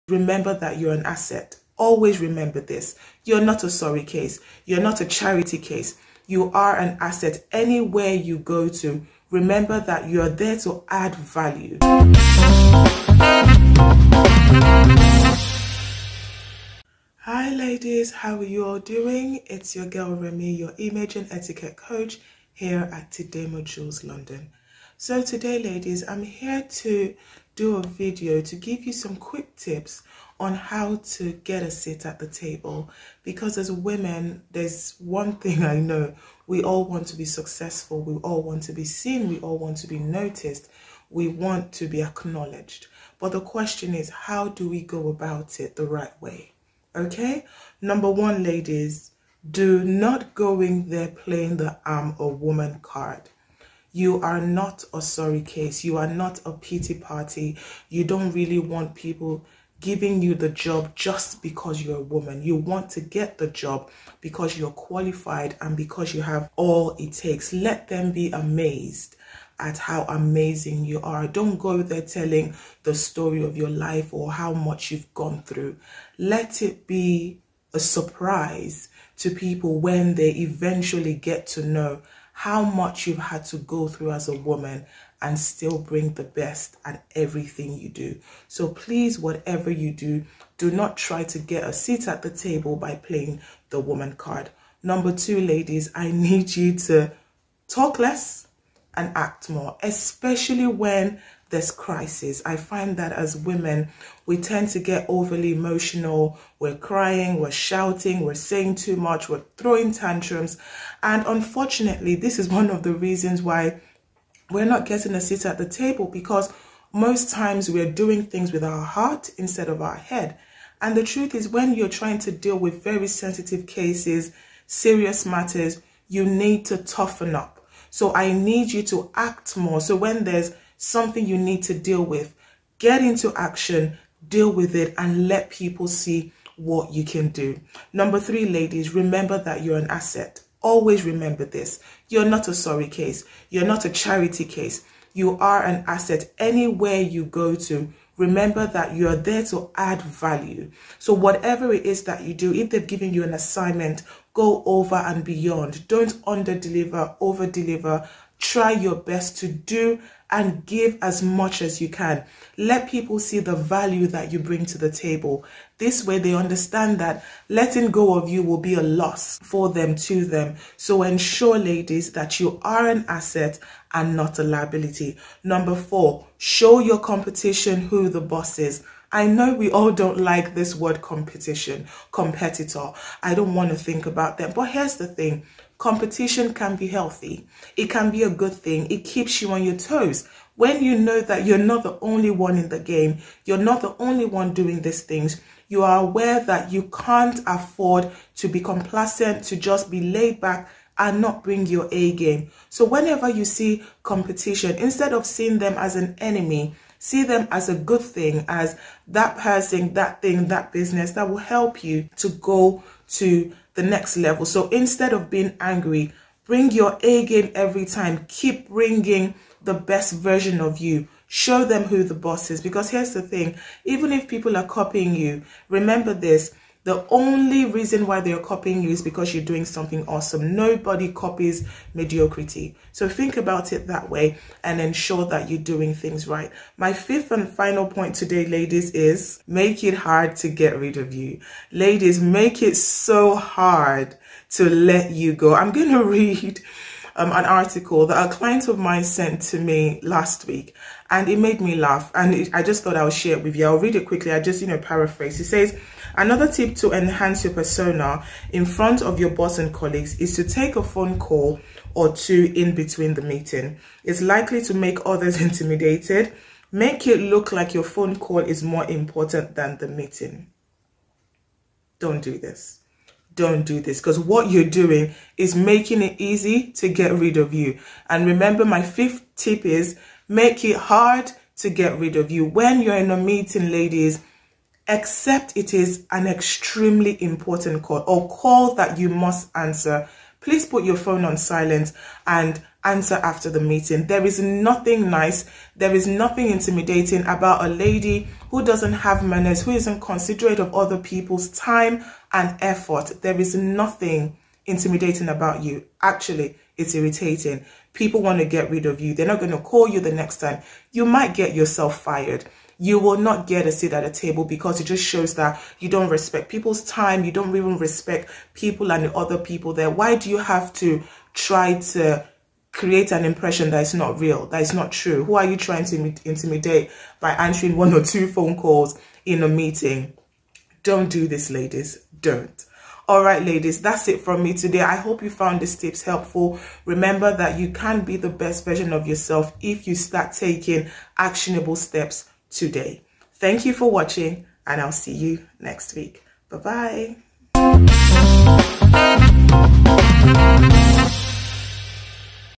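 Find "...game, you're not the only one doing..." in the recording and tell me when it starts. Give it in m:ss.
3:12.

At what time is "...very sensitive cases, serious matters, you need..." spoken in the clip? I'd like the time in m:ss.
2:02.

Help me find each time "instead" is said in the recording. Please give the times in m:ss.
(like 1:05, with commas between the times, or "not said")
1:59, 3:24, 3:34.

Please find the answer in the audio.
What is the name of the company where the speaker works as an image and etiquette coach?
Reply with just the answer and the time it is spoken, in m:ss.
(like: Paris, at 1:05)
Tidemma Jewels London, at 0:23.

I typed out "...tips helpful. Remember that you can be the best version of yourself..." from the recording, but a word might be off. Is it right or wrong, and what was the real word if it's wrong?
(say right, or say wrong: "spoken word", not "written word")
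right.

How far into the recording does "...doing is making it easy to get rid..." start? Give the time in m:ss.
4:34.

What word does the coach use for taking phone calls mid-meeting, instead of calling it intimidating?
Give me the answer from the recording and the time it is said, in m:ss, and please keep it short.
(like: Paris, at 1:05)
Irritating, at 5:06.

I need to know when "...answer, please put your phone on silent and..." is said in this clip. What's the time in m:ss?
4:49.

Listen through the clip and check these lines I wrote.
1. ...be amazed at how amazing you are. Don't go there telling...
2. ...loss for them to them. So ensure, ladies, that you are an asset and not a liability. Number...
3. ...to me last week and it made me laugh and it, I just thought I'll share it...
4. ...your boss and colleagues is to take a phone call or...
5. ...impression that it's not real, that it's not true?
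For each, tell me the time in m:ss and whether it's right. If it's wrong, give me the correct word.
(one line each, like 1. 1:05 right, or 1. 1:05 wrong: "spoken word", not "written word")
1. 1:08 right
2. 2:48 right
3. 4:09 right
4. 4:19 right
5. 5:23 right.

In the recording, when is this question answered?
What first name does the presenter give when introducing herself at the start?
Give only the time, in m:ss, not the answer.
0:20.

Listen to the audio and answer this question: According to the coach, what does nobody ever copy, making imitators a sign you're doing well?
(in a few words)
Mediocrity.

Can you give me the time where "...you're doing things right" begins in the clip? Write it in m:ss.
3:55.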